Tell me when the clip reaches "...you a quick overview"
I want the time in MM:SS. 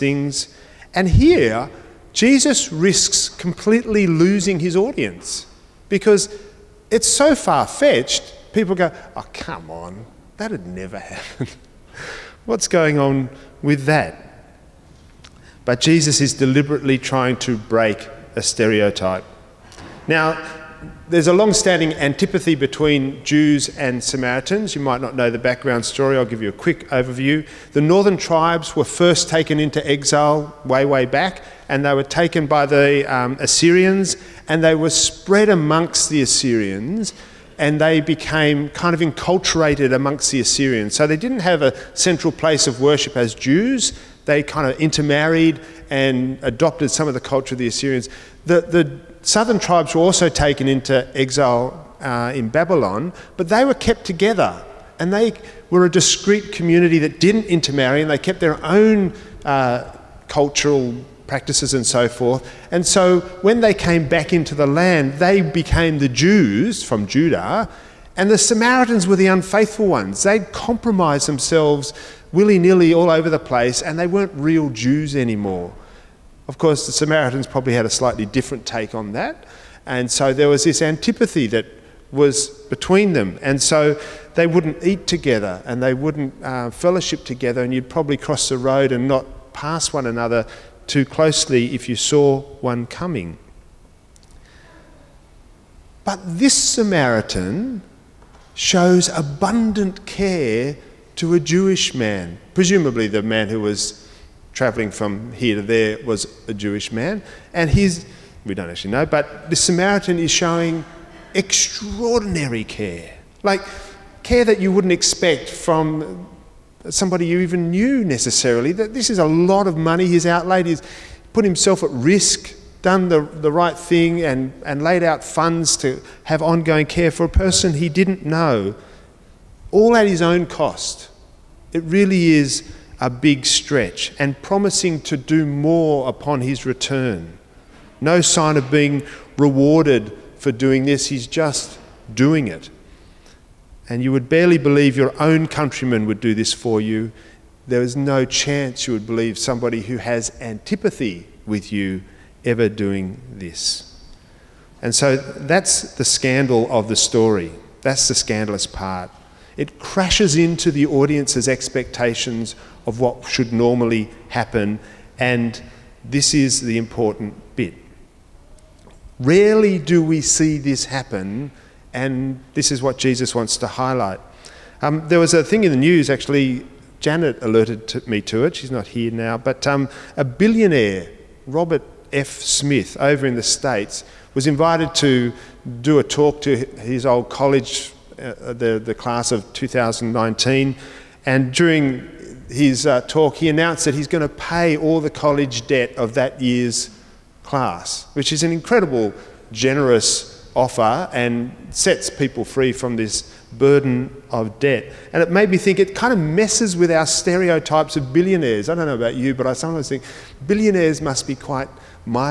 00:26.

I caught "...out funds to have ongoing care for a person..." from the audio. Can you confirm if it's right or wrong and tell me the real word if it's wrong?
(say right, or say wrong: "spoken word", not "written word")
right.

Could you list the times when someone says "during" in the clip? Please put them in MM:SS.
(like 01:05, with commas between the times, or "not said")
03:11.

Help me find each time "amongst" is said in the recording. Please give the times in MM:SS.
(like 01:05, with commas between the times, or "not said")
00:35, 00:39.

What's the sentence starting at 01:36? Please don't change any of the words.
But this Samaritan shows abundant care to a Jewish man.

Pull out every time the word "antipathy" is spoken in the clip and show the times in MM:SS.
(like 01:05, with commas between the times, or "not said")
00:21, 01:20, 02:30.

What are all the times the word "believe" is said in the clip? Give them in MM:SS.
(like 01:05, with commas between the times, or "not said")
02:24, 02:29.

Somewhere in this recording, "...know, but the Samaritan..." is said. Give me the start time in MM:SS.
01:48.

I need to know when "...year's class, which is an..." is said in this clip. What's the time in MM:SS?
03:16.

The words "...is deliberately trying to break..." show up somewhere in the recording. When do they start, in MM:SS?
00:16.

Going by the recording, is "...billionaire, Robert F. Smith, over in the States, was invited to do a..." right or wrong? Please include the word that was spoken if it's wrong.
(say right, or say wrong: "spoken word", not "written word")
right.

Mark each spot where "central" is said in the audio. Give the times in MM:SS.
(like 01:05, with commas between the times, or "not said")
00:41.